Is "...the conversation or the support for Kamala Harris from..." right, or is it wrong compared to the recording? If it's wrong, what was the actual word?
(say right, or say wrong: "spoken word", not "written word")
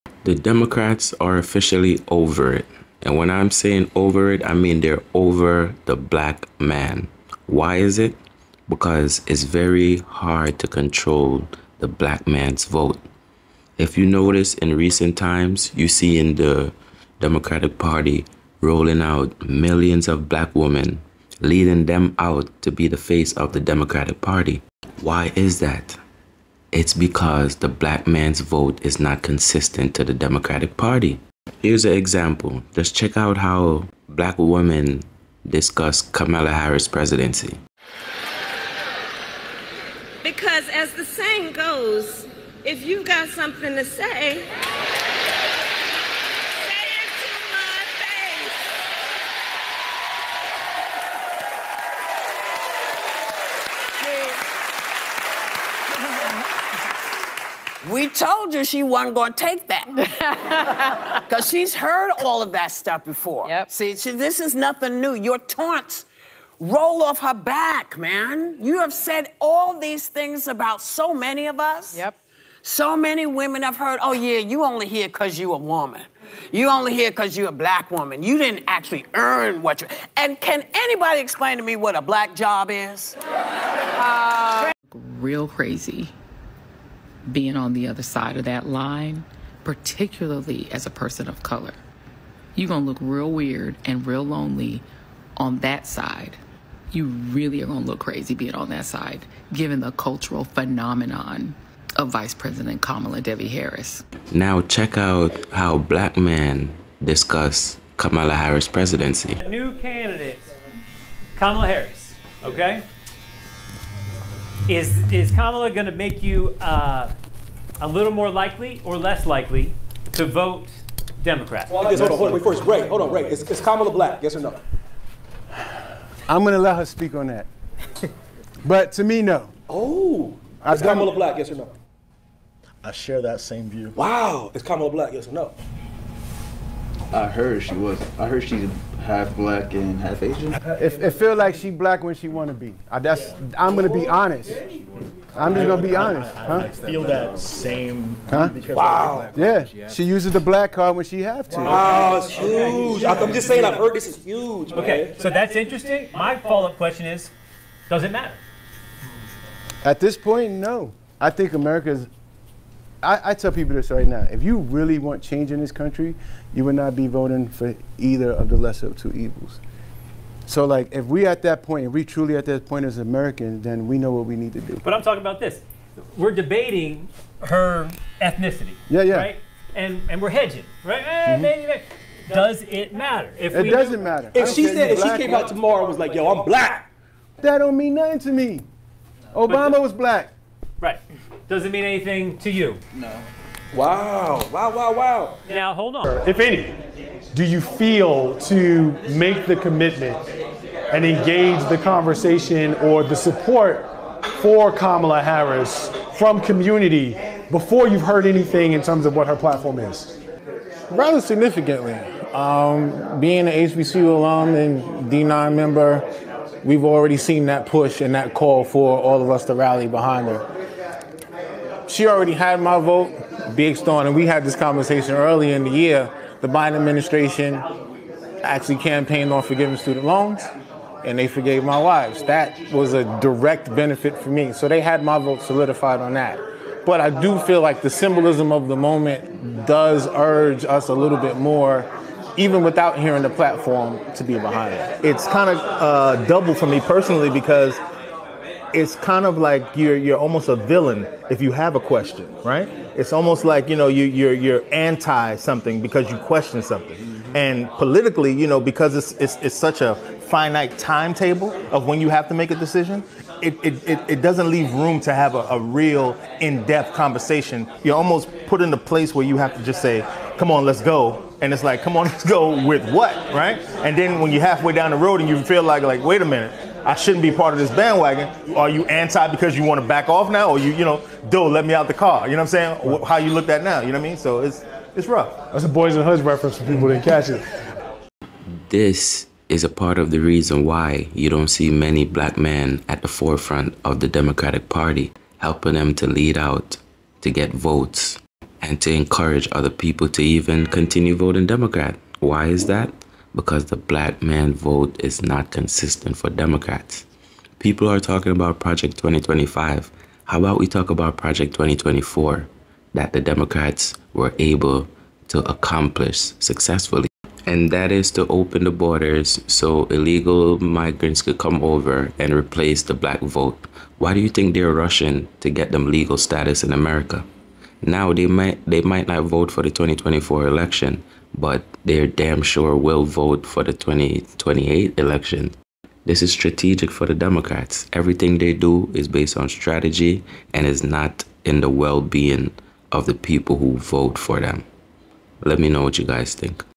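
right.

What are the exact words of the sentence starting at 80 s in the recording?
And can anybody explain to me what a black job is?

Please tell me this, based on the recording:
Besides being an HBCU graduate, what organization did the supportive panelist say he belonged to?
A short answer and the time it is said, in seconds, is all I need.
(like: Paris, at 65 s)
D9, at 215 s.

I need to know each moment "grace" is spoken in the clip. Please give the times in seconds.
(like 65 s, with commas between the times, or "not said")
not said.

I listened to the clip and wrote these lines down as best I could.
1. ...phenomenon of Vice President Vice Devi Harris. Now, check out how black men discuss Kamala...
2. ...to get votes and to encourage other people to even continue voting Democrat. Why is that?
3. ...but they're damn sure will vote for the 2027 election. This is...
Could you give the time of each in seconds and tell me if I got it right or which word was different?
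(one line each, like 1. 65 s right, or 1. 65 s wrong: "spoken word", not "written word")
1. 100 s wrong: "Kamala", not "Vice"
2. 297 s right
3. 331 s wrong: "2028", not "2027".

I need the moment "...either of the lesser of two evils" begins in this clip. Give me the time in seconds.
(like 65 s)
167 s.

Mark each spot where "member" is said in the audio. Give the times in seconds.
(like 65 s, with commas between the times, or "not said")
215 s.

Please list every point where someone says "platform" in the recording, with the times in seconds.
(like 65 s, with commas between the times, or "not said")
209 s, 243 s.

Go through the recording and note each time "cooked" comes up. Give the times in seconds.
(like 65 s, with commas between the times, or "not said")
not said.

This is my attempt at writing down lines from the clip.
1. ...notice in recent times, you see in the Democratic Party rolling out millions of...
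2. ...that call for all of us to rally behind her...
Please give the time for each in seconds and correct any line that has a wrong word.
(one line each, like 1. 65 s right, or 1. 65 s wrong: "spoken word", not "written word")
1. 14 s right
2. 218 s right.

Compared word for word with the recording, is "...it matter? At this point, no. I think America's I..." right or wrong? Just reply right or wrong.
right.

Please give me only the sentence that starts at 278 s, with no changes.
Are you anti because you want to back off now, or you, you know, do let me out the car?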